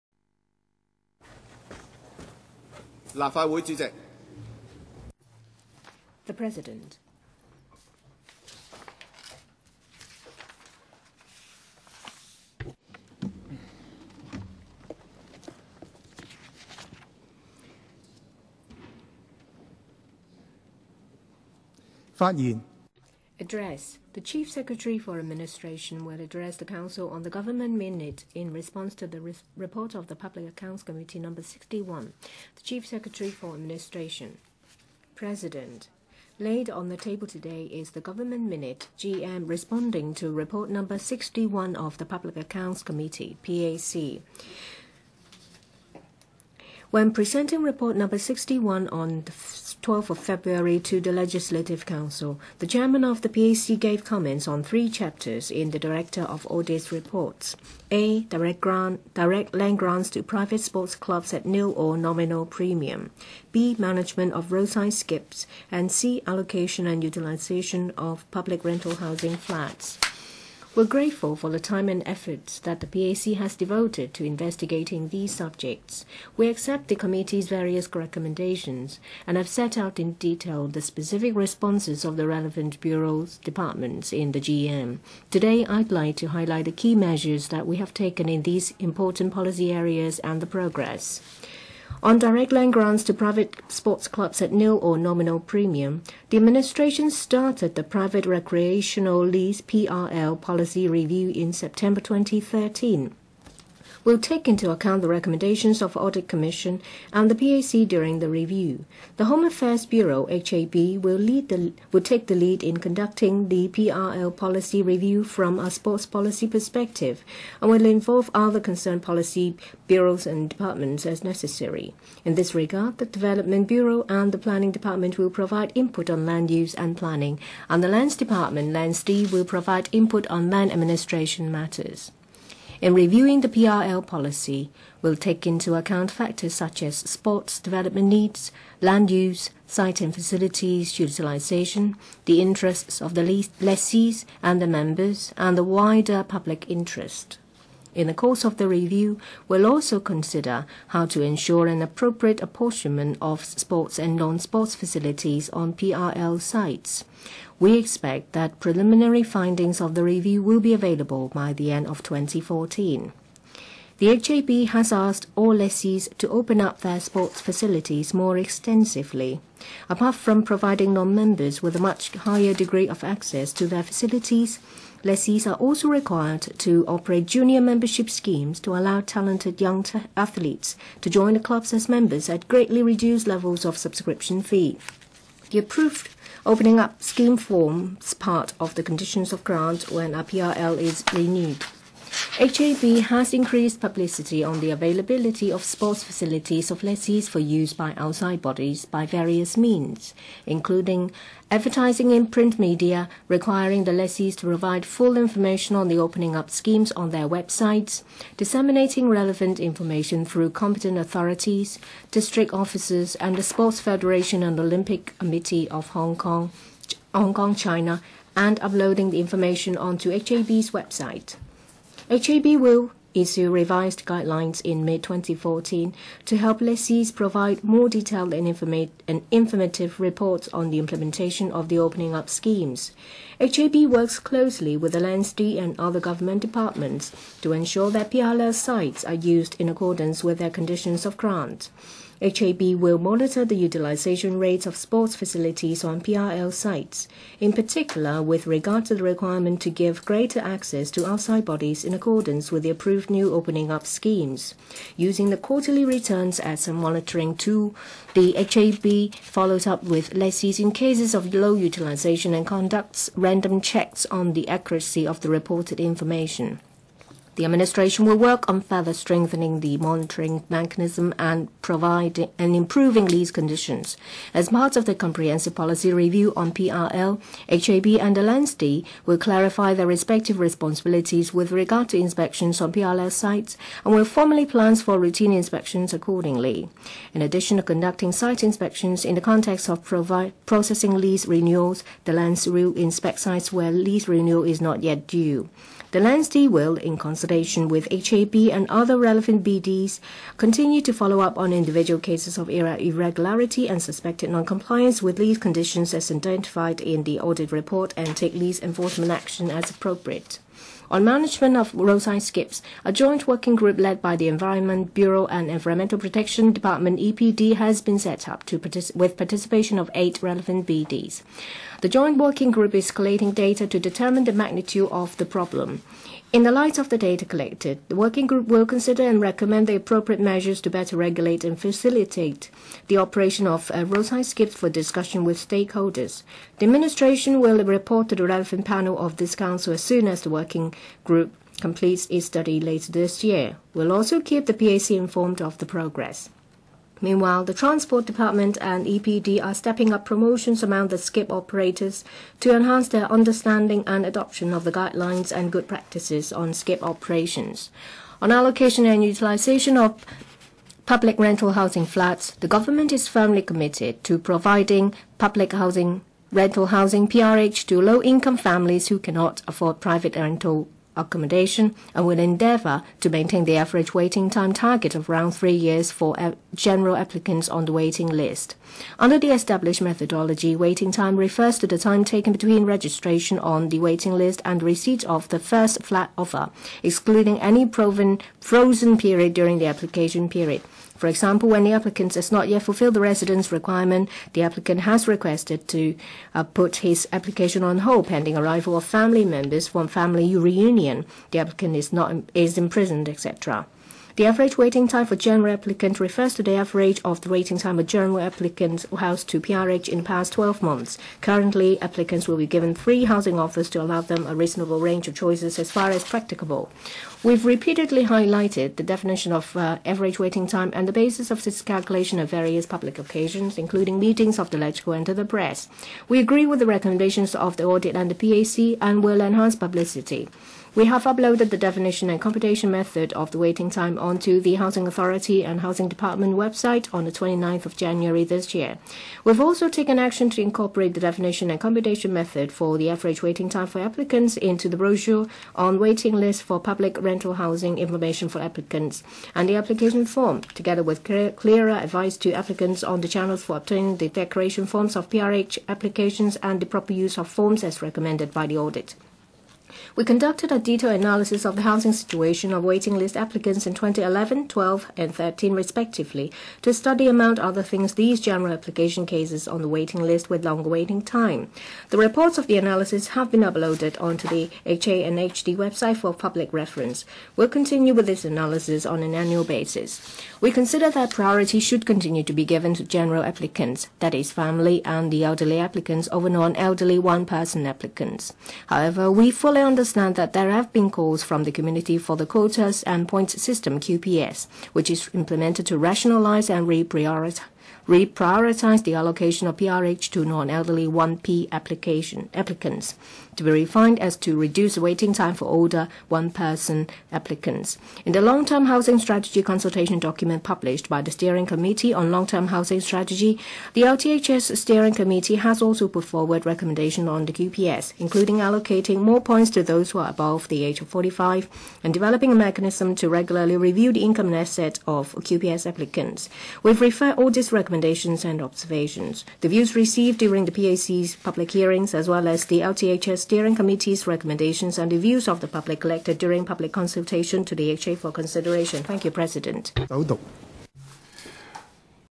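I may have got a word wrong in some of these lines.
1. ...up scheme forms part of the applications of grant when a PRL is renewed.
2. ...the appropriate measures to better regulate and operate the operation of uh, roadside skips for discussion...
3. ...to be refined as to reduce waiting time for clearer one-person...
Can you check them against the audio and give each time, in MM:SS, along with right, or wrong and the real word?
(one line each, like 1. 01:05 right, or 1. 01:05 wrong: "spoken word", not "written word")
1. 03:06 wrong: "conditions", not "applications"
2. 05:29 wrong: "facilitate", not "operate"
3. 08:23 wrong: "older", not "clearer".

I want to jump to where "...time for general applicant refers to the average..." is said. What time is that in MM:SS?
06:44.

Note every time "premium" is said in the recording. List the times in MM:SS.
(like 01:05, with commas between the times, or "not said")
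01:02, 01:35.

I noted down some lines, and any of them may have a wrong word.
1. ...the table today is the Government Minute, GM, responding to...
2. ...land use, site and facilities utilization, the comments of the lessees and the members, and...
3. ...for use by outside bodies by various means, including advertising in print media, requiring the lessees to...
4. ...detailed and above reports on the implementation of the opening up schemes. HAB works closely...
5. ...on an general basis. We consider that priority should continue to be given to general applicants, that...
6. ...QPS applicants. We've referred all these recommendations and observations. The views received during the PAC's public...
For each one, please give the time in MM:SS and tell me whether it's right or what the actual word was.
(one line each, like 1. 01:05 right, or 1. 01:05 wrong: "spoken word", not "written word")
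1. 00:36 right
2. 02:18 wrong: "interests", not "comments"
3. 03:17 right
4. 03:47 wrong: "informative", not "above"
5. 07:58 wrong: "annual", not "general"
6. 08:45 right.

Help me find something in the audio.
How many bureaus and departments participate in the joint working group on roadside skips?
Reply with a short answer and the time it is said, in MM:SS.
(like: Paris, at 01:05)
8, at 05:19.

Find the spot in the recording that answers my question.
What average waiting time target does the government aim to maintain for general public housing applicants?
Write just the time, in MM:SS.
06:15.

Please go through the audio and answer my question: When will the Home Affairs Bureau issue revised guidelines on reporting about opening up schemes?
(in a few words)
Mid-2014.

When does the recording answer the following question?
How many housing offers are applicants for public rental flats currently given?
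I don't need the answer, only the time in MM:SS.
06:52.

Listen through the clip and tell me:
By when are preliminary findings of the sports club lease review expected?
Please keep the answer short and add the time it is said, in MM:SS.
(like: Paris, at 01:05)
End of 2014, at 02:41.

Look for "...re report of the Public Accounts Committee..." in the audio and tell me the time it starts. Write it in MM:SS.
00:29.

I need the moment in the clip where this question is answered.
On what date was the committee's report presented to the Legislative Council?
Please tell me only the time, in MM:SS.
00:49.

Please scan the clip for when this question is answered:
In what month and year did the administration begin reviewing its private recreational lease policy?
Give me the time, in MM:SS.
01:41.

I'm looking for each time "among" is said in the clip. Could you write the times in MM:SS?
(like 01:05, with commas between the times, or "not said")
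05:50, 07:47.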